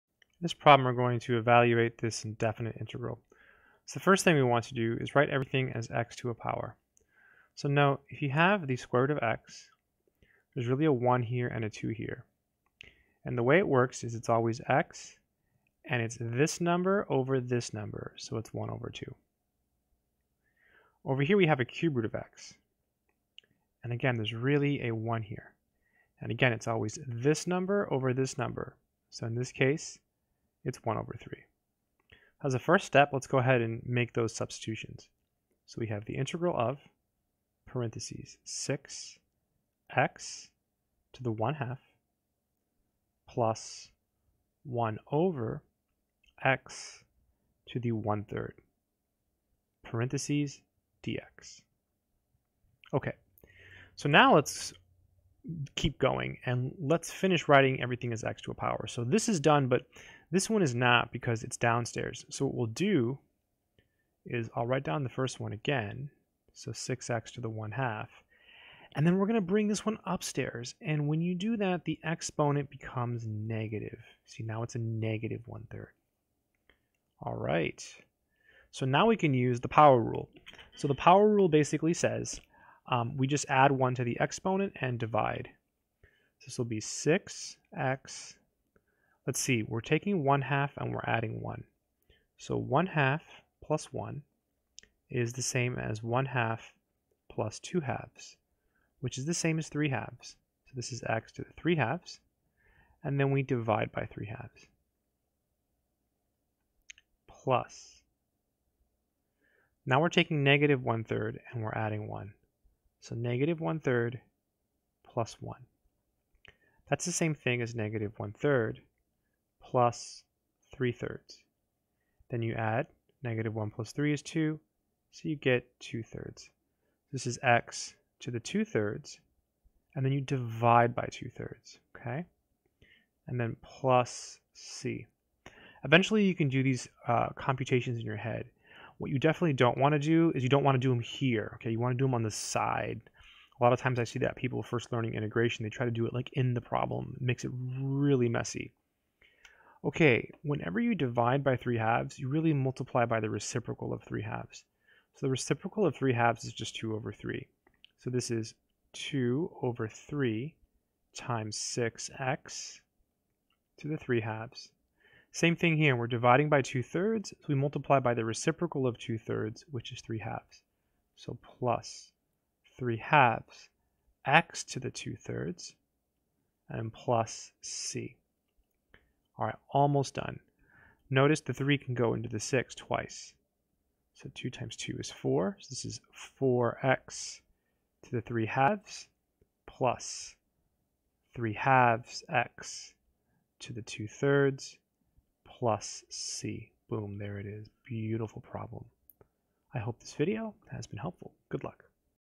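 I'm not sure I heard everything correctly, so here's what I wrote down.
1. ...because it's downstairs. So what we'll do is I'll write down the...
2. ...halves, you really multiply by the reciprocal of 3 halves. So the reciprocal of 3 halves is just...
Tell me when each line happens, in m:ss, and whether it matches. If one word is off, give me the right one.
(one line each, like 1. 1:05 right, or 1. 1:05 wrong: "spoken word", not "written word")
1. 1:01 right
2. 2:31 right.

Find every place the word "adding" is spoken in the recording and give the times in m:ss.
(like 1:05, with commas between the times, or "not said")
1:31, 1:51.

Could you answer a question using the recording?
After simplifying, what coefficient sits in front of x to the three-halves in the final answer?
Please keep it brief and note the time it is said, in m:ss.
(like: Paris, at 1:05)
4, at 3:06.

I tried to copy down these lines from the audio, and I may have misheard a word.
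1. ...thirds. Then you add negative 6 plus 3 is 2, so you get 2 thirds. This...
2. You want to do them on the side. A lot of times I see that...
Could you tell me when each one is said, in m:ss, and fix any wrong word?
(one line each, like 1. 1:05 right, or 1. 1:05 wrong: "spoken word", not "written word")
1. 2:00 wrong: "1", not "6"
2. 2:21 right.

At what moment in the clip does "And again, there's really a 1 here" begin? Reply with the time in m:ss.
0:23.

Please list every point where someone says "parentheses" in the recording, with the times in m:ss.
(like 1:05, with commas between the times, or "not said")
0:37, 0:49.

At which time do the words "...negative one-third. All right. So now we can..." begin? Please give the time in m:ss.
1:14.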